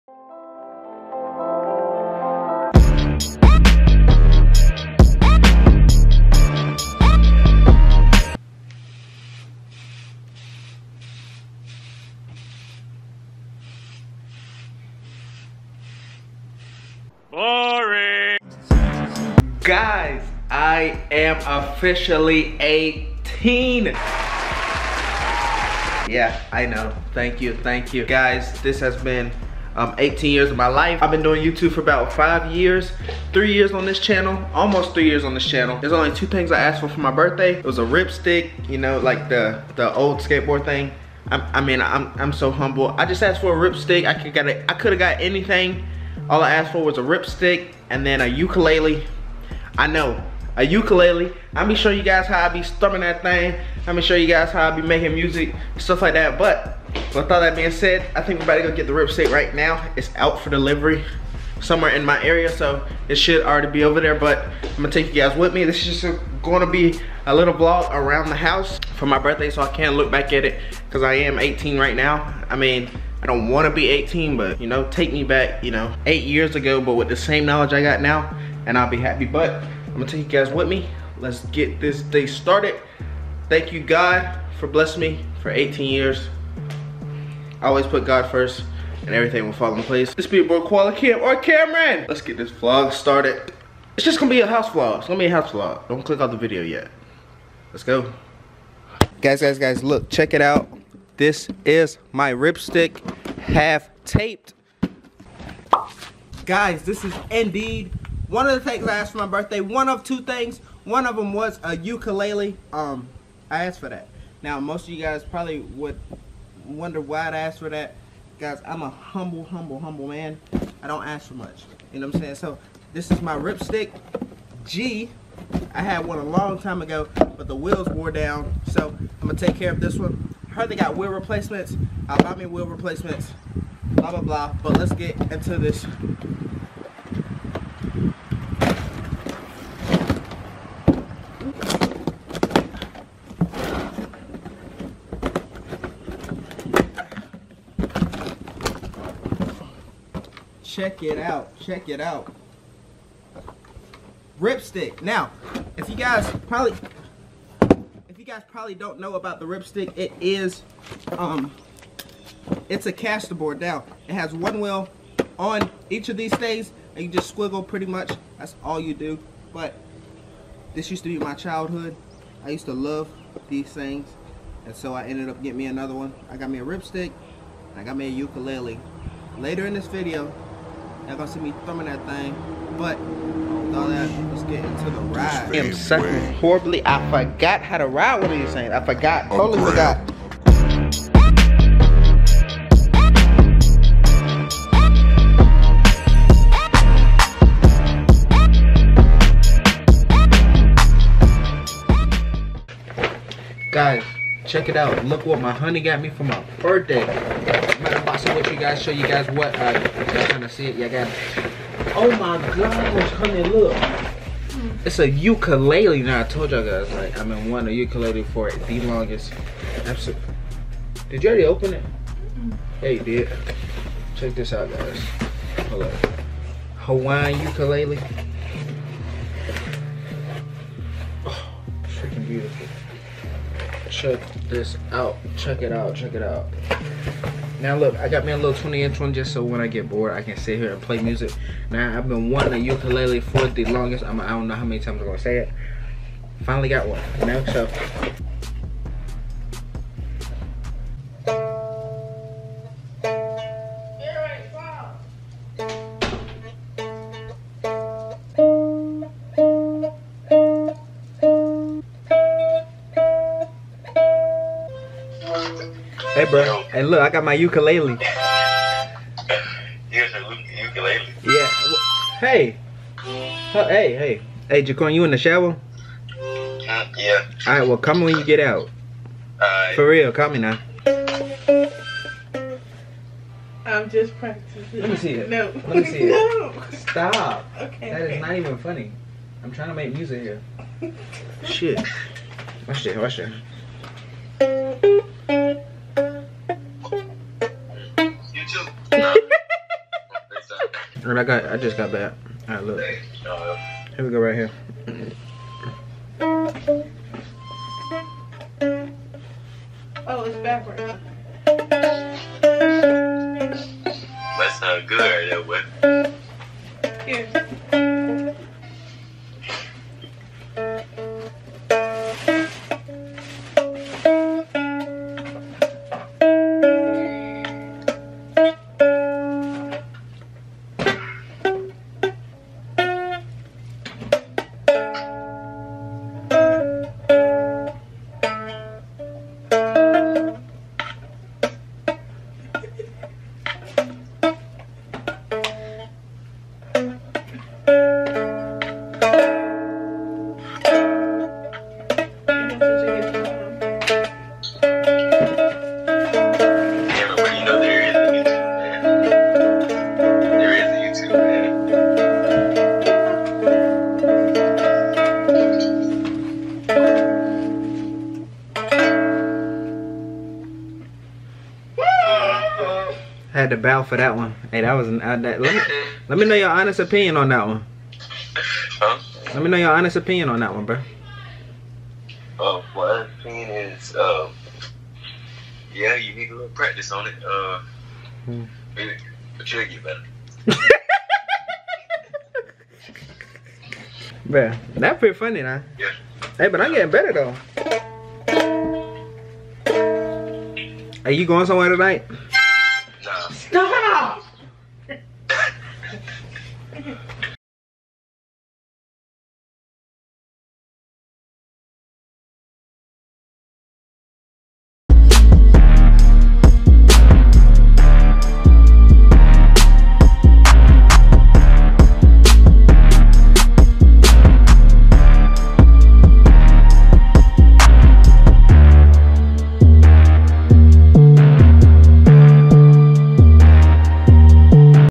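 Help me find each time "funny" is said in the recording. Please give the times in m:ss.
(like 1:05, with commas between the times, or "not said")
4:48, 6:35.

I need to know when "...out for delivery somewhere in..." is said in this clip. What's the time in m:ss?
1:00.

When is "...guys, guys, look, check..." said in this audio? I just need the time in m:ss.
1:39.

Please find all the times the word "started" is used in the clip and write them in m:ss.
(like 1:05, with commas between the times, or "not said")
1:22, 1:32.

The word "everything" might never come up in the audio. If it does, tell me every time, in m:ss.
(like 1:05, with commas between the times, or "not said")
1:29.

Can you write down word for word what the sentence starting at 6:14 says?
Hey, that was uh, that, let, me, let me know your honest opinion on that one.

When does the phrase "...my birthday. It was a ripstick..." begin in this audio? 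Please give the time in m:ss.
0:36.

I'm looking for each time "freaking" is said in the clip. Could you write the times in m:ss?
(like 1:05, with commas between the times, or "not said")
3:51.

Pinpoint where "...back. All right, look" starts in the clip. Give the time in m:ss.
5:01.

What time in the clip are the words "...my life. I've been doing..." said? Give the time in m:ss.
0:30.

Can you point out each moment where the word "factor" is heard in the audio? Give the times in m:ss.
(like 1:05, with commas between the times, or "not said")
not said.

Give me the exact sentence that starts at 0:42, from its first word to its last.
I just asked for a ripstick.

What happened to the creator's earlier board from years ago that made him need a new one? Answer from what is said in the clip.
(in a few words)
The wheels wore down.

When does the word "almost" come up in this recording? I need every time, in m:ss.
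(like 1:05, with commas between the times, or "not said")
0:34.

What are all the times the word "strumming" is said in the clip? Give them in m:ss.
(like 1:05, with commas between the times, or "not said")
0:52.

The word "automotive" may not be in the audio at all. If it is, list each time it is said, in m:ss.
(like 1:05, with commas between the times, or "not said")
not said.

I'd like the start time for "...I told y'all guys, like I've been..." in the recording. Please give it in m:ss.
3:36.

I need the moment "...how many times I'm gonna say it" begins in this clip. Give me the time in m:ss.
4:04.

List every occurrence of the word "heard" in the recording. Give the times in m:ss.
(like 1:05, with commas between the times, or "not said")
2:10.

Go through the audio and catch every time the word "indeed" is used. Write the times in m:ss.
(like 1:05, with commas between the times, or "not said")
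1:47.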